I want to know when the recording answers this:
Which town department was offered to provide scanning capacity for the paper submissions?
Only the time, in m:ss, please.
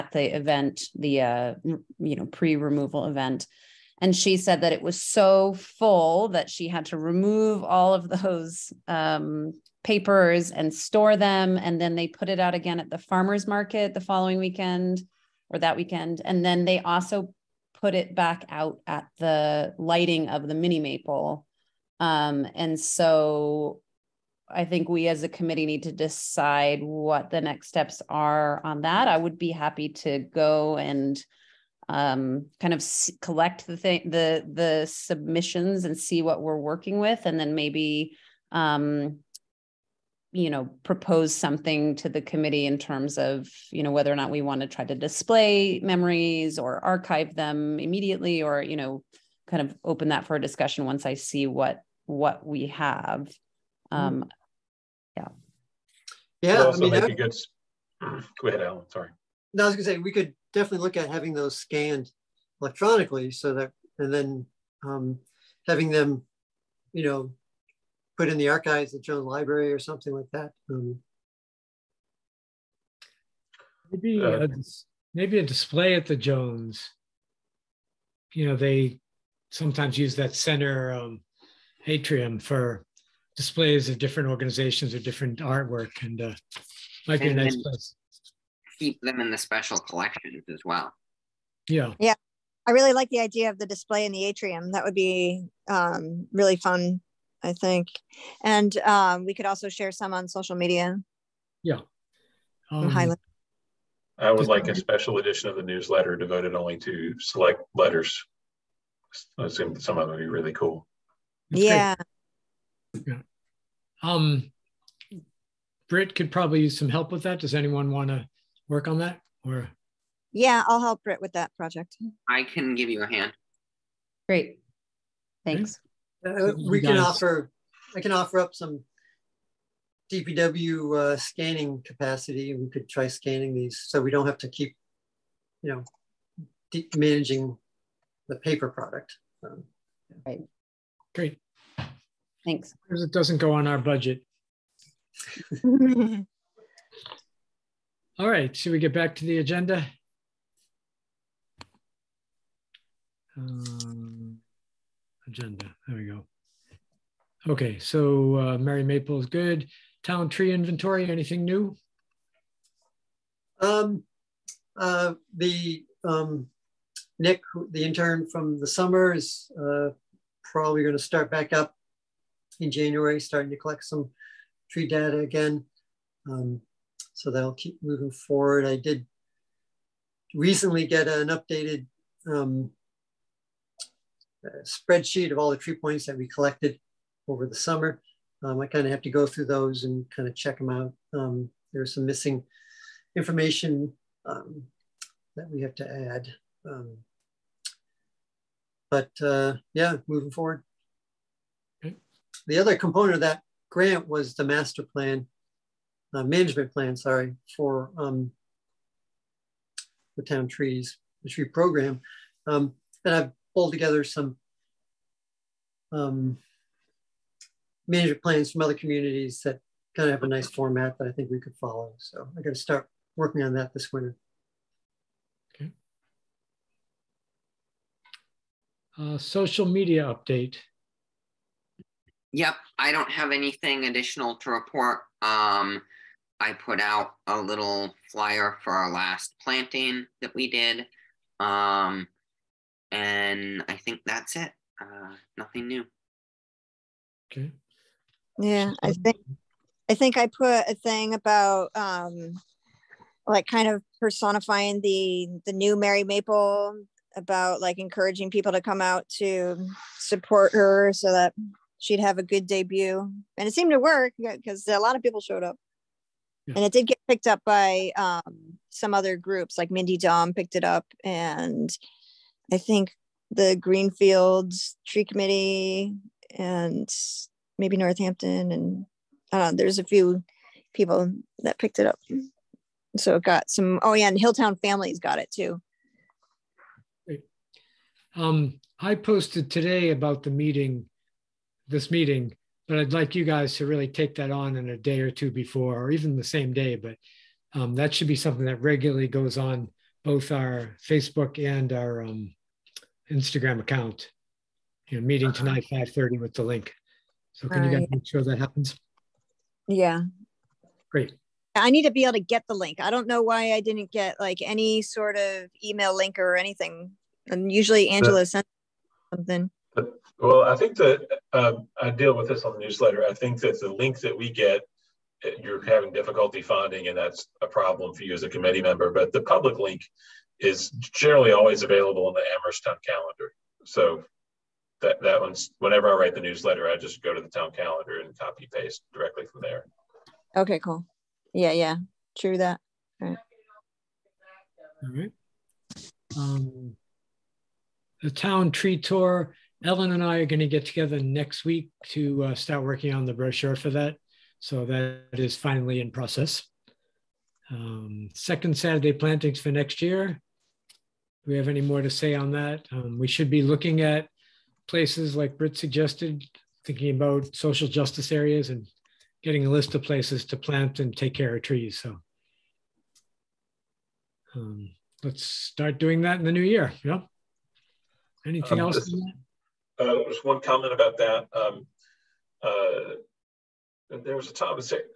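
2:10.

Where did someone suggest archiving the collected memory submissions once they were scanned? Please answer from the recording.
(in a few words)
Jones Library.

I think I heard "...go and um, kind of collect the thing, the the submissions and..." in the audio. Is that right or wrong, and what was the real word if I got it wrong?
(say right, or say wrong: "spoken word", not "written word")
right.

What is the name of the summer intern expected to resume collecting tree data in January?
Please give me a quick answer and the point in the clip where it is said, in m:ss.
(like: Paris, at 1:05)
Nick, at 2:47.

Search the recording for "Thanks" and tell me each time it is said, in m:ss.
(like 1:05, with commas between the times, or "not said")
2:05, 2:22.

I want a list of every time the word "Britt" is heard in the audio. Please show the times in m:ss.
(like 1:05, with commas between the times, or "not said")
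1:55, 2:01, 6:05.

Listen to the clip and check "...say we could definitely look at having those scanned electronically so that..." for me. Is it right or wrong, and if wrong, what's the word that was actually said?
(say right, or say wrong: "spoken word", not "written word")
right.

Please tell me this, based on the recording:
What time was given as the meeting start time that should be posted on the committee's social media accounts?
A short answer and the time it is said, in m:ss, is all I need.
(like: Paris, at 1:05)
5:30, at 5:05.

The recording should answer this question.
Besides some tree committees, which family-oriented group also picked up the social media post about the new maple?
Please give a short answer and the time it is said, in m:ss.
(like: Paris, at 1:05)
Hilltown Families, at 4:44.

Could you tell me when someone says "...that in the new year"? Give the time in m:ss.
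6:16.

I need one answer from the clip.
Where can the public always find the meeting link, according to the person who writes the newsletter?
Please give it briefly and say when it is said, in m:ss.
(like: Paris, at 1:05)
Amherst Town Calendar, at 5:32.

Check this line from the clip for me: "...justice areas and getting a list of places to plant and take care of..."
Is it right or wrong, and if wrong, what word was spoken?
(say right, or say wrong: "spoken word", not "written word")
right.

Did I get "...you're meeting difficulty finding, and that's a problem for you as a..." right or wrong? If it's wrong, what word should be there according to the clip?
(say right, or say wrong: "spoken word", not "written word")
wrong: "having", not "meeting".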